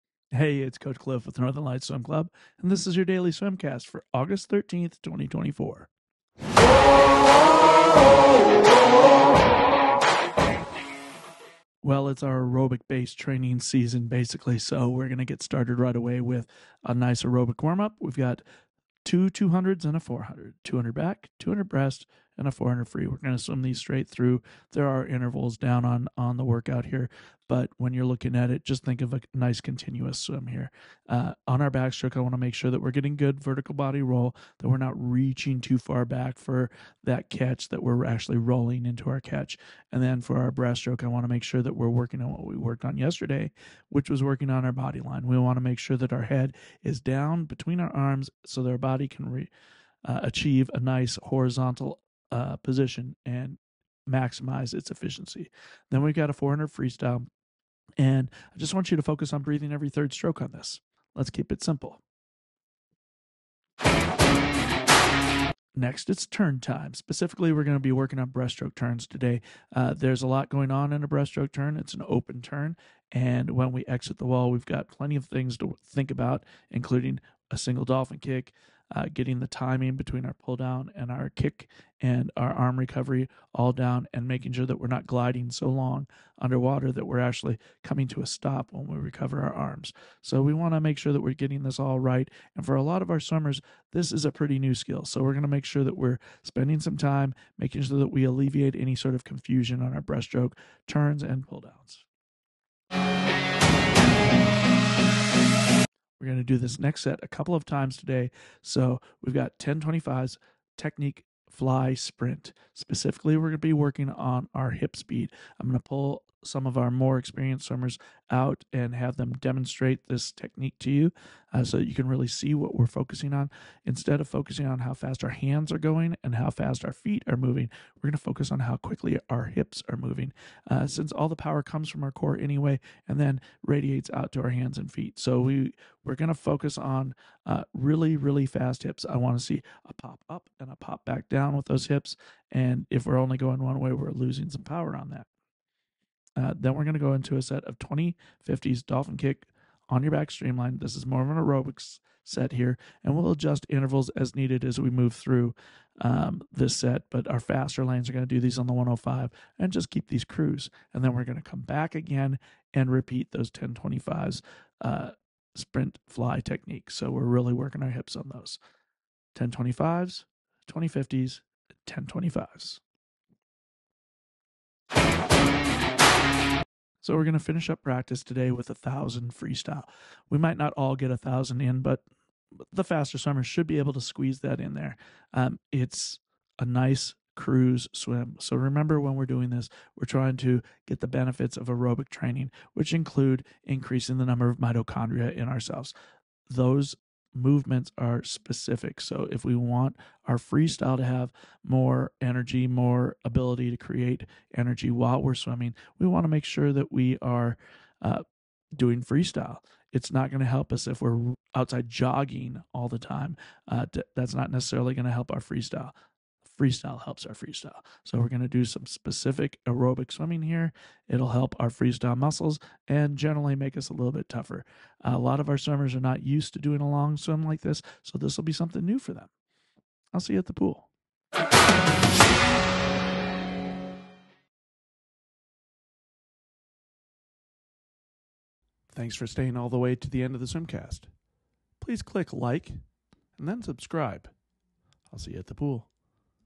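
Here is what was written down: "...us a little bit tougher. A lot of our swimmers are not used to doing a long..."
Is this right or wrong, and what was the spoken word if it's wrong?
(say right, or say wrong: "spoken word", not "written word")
right.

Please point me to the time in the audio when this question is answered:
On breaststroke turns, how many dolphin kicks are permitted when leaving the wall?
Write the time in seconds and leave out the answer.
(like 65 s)
77 s.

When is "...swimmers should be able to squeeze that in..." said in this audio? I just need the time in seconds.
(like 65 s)
183 s.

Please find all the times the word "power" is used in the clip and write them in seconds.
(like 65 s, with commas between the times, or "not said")
131 s, 144 s.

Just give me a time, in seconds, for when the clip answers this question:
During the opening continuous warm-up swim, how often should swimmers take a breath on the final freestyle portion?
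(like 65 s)
59 s.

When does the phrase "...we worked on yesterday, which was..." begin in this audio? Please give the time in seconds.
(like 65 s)
42 s.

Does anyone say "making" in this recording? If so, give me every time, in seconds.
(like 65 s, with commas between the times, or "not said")
84 s, 97 s.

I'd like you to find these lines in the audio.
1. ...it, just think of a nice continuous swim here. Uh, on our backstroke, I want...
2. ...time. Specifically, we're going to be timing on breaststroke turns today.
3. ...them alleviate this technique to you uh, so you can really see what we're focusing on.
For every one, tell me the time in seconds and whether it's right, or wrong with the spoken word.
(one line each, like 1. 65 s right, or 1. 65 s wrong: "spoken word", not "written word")
1. 28 s right
2. 66 s wrong: "working", not "timing"
3. 119 s wrong: "demonstrate", not "alleviate".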